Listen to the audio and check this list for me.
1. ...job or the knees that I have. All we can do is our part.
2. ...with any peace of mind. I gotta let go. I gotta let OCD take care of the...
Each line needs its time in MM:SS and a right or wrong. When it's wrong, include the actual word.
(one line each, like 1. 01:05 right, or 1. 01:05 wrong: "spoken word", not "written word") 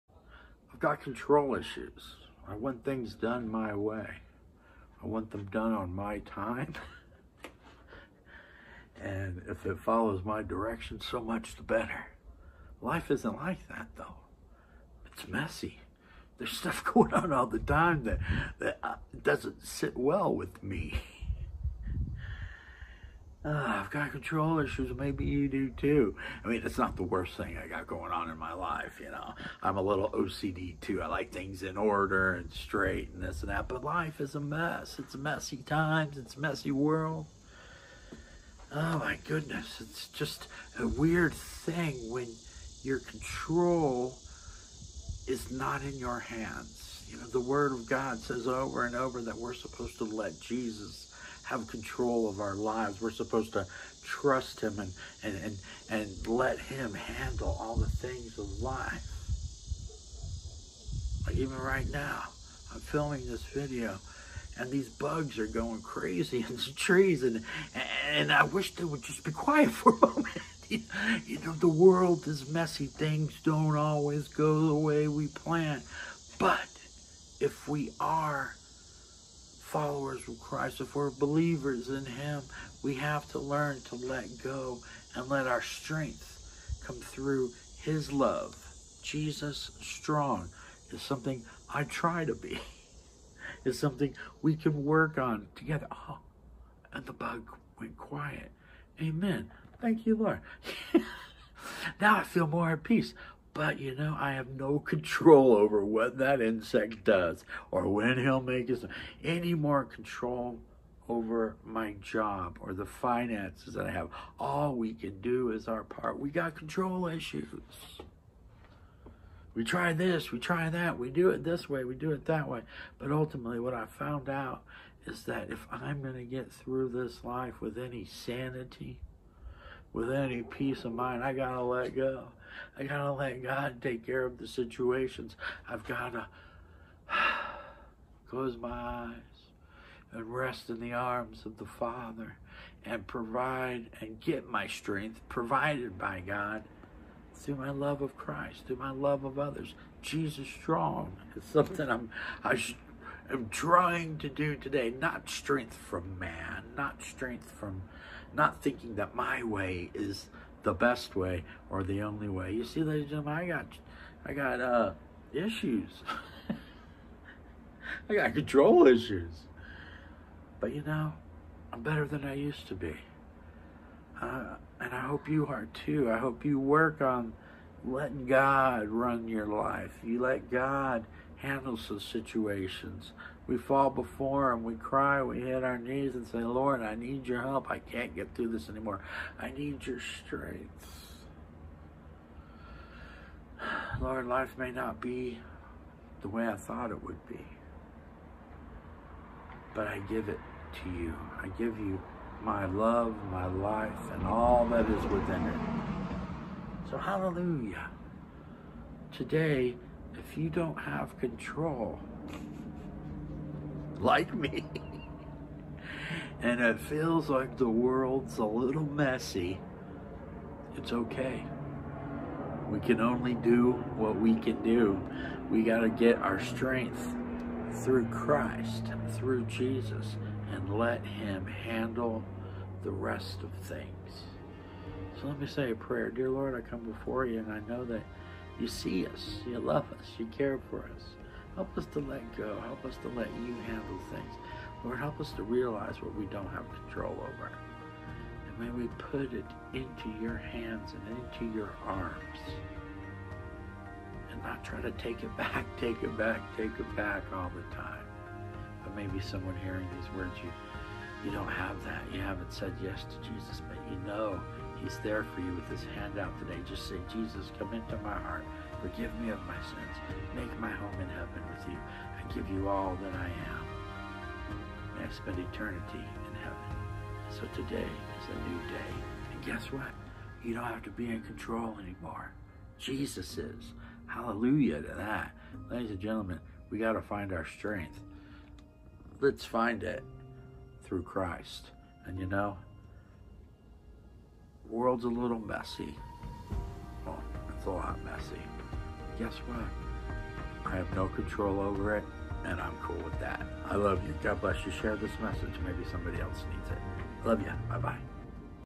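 1. 01:52 wrong: "finances", not "knees"
2. 02:09 wrong: "God", not "OCD".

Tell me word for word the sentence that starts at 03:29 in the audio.
Today, if you don't have control, like me.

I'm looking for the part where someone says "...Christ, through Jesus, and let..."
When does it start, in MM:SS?
03:48.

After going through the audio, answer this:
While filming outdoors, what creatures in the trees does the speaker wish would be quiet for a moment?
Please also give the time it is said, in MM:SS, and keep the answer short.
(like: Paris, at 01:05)
Bugs, at 01:04.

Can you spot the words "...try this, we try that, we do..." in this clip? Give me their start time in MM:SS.
01:59.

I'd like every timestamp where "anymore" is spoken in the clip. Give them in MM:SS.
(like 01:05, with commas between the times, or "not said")
03:08, 04:41.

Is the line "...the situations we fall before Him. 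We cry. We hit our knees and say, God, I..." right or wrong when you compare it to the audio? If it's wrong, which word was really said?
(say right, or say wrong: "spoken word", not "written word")
wrong: "Lord", not "God".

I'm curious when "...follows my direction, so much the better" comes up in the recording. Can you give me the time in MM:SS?
00:09.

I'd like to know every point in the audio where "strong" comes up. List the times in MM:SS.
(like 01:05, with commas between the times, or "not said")
01:29, 02:30.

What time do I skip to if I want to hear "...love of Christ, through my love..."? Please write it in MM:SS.
02:27.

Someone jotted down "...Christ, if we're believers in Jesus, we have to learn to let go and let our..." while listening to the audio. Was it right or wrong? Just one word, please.
wrong.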